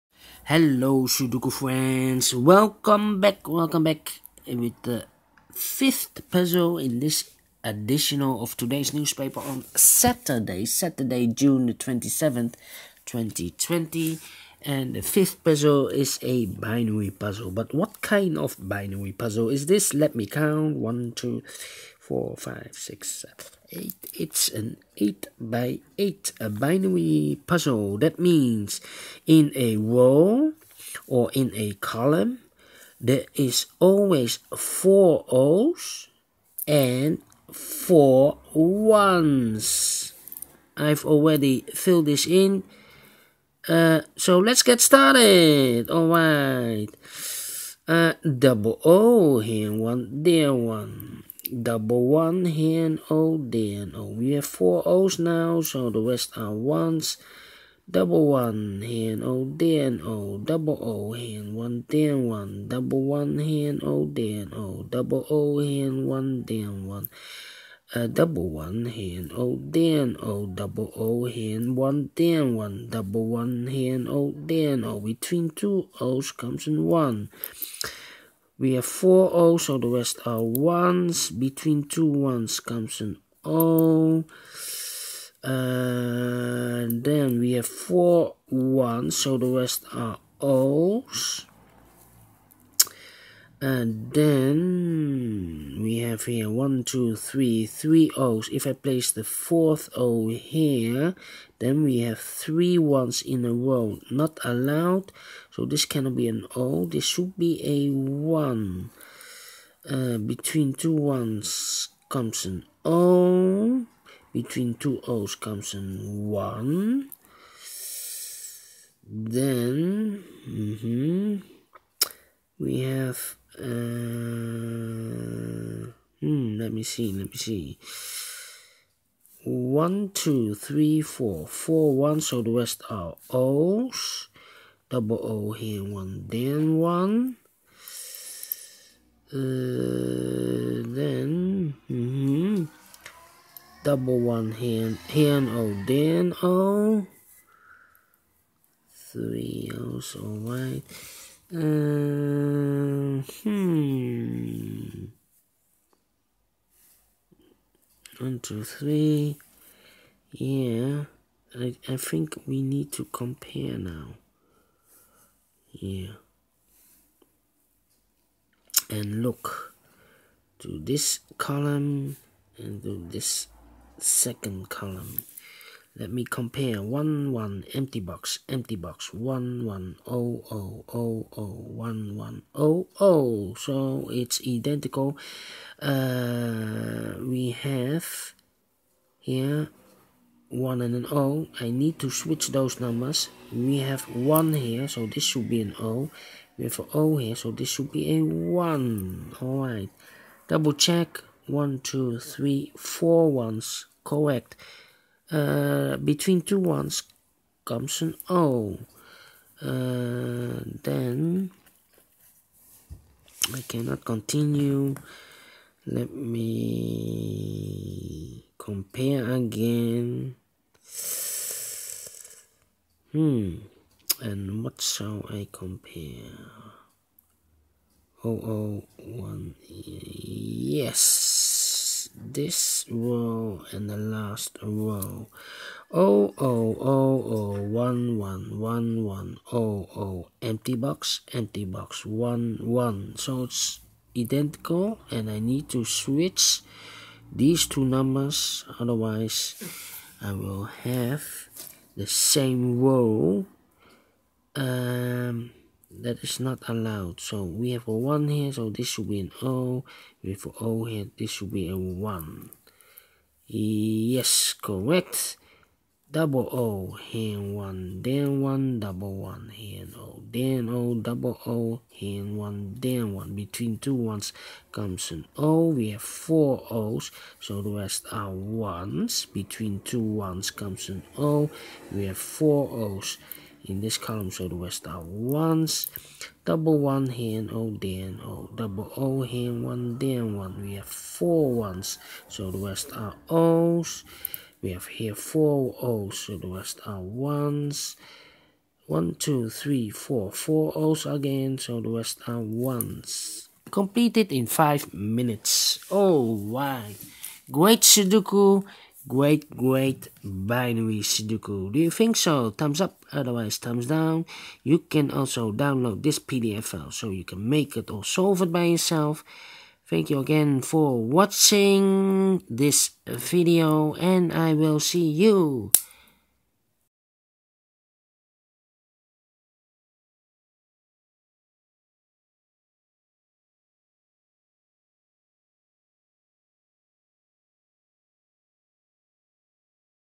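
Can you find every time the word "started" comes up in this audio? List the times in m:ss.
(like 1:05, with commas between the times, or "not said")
0:44.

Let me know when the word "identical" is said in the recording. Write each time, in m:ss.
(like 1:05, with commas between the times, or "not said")
3:04, 4:04.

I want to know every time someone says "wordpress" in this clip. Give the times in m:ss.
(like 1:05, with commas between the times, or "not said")
not said.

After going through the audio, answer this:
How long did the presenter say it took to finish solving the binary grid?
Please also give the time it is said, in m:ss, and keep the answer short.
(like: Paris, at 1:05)
5 minutes, at 5:04.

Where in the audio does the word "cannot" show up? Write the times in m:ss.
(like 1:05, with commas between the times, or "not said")
1:45, 3:33.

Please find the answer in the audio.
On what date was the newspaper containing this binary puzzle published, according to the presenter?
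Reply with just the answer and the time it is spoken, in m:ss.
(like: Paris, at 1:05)
June 27th, 2020, at 0:11.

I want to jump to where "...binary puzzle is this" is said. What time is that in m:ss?
0:18.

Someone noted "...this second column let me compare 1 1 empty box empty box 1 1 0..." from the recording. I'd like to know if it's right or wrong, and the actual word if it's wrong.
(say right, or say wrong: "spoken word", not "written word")
right.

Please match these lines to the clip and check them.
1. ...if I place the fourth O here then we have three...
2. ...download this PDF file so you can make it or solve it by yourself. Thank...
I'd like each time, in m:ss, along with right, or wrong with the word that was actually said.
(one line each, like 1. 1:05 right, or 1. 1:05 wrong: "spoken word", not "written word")
1. 1:38 right
2. 5:15 right.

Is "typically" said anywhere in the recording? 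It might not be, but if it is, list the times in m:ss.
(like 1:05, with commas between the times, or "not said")
not said.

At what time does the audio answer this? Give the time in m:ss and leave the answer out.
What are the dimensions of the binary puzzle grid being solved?
0:24.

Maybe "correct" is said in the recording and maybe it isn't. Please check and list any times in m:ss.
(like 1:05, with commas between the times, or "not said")
3:24, 4:24.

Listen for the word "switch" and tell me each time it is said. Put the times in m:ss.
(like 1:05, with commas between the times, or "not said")
3:12, 4:05.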